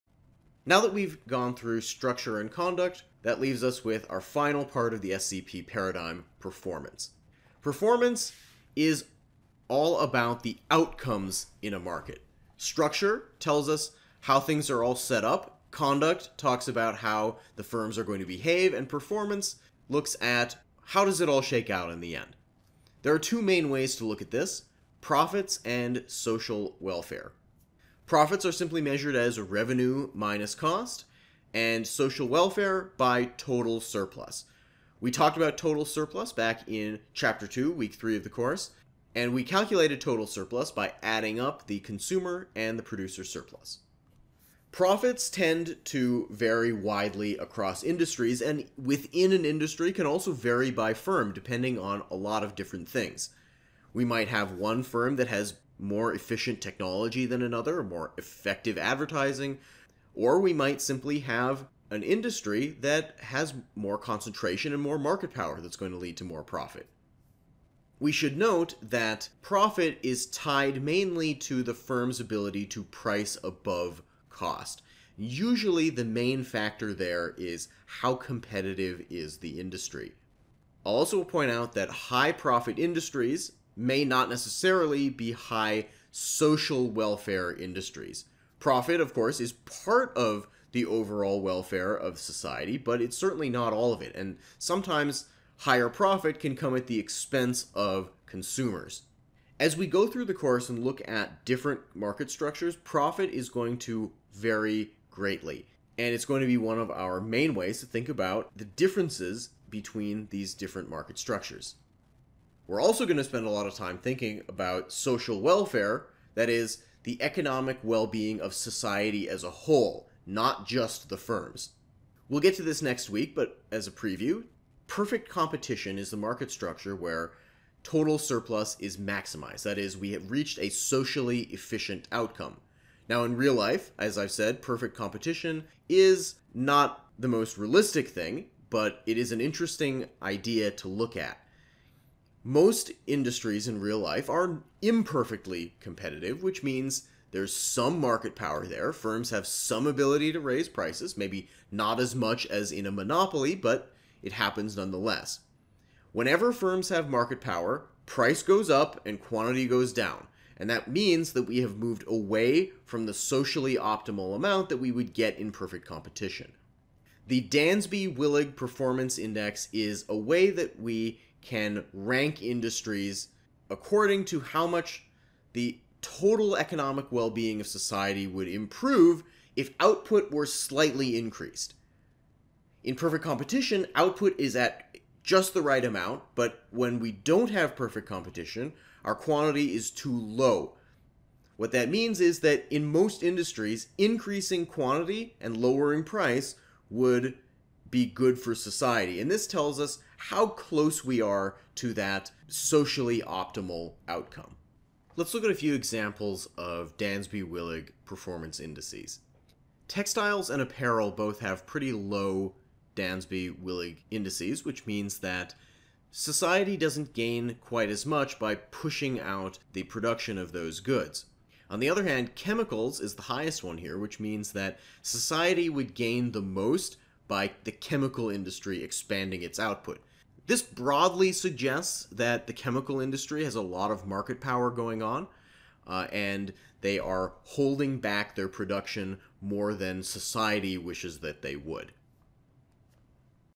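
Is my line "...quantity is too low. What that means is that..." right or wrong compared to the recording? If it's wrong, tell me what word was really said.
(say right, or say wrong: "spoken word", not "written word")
right.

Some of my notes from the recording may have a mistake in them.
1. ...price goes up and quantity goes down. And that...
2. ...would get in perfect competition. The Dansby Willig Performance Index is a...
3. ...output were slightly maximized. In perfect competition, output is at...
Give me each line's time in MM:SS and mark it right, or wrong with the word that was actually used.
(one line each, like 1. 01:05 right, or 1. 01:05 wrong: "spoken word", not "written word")
1. 02:38 right
2. 02:44 right
3. 02:59 wrong: "increased", not "maximized".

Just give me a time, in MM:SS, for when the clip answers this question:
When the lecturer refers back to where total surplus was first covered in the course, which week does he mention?
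00:37.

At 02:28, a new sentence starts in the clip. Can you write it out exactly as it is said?
Firms have some ability to raise prices, maybe not as much as in a monopoly, but it happens nonetheless.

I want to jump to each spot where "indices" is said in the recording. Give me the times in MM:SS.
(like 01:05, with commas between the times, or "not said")
03:28, 03:34.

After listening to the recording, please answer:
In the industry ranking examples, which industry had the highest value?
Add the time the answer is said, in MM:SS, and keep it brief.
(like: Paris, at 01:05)
chemicals, at 03:42.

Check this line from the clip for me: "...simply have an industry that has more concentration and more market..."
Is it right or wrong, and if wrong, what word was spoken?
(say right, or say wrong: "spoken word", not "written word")
right.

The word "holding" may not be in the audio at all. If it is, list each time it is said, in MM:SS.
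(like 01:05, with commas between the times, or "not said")
03:57.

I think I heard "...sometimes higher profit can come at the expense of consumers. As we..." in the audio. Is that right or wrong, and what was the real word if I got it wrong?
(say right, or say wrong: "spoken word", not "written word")
right.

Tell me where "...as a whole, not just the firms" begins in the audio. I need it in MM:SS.
01:59.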